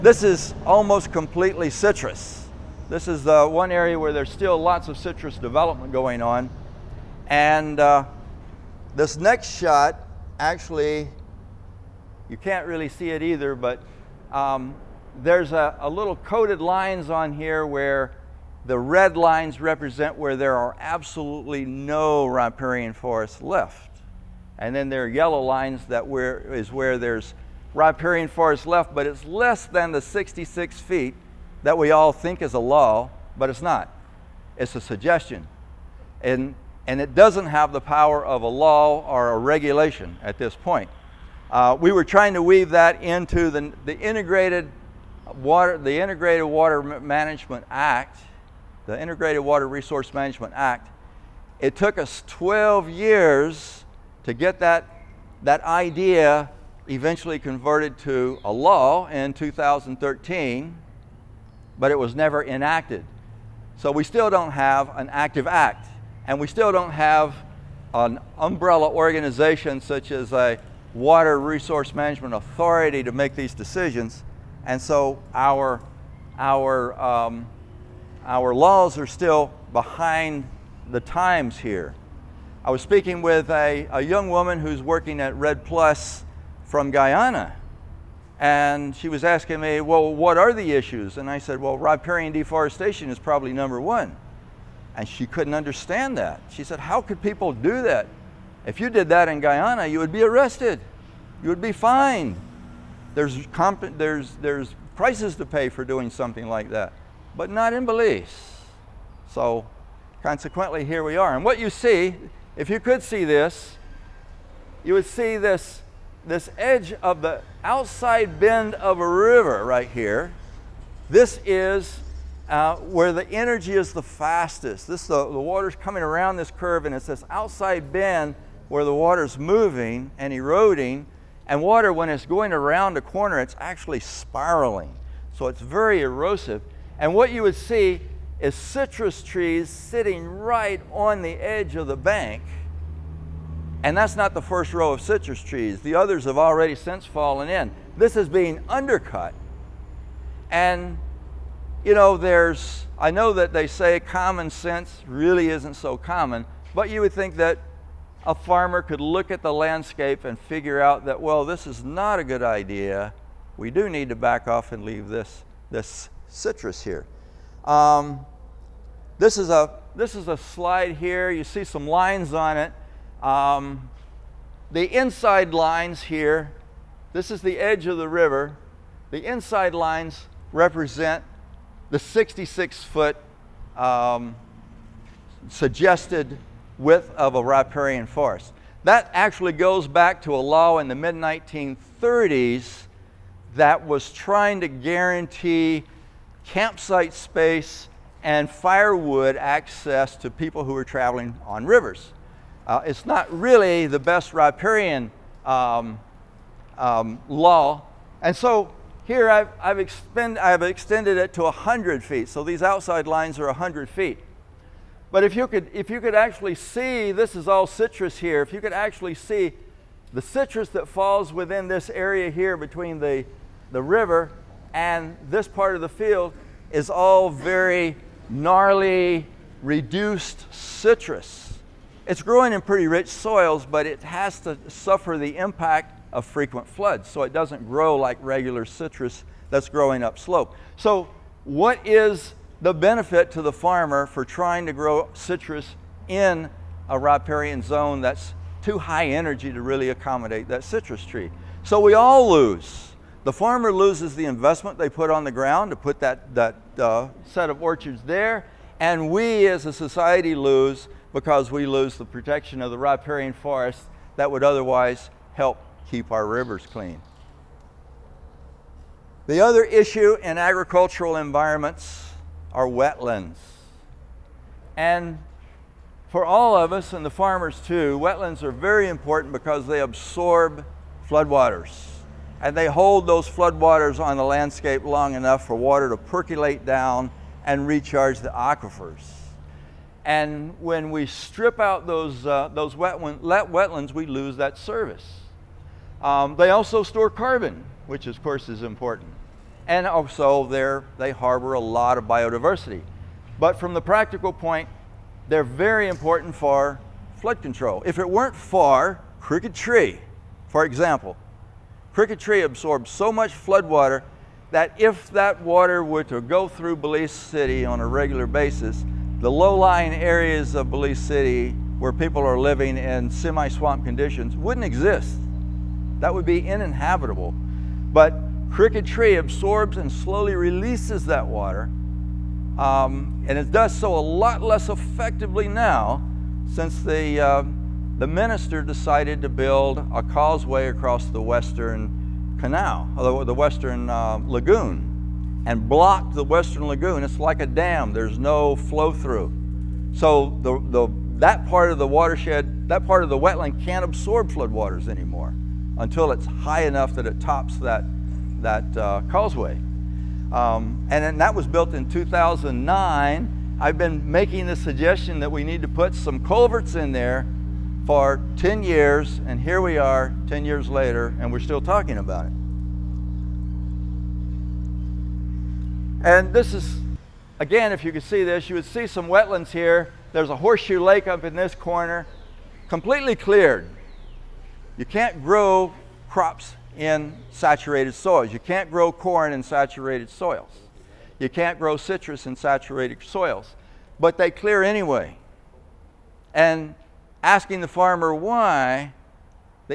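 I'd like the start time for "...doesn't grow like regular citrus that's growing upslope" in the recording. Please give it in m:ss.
3:57.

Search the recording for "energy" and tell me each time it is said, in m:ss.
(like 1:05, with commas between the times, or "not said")
2:03, 4:09.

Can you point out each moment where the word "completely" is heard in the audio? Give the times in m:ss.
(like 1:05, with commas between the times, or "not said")
0:01, 6:22.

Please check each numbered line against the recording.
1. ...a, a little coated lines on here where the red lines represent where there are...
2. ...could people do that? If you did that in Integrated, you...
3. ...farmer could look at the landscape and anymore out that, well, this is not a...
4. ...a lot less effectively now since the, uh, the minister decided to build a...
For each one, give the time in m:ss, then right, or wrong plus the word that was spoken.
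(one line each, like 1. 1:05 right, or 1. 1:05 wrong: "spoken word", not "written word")
1. 0:15 right
2. 1:37 wrong: "Guyana", not "Integrated"
3. 2:38 wrong: "figure", not "anymore"
4. 5:33 right.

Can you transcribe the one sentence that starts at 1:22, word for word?
I was speaking with a, a young woman who's working at REDD+ from Guyana.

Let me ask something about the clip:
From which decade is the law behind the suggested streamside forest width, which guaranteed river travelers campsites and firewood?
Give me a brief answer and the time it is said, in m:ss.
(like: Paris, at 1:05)
mid 1930s, at 3:10.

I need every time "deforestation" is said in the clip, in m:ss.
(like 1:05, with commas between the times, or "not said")
1:32.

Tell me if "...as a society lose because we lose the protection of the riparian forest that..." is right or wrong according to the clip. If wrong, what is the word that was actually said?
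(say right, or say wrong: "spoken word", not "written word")
right.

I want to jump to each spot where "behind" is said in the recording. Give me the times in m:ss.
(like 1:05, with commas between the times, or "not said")
1:19.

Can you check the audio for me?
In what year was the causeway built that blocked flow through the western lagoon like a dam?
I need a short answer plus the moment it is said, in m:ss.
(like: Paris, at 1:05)
2009, at 6:01.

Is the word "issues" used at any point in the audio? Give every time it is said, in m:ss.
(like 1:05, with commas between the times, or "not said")
1:30, 4:29.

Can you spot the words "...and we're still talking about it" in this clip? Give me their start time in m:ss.
6:11.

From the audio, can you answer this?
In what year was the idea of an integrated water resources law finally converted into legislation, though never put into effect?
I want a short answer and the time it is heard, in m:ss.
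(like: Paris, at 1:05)
2013, at 0:59.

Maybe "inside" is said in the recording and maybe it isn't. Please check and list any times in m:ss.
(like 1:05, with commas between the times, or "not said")
2:54, 2:59.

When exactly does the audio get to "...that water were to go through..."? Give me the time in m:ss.
5:15.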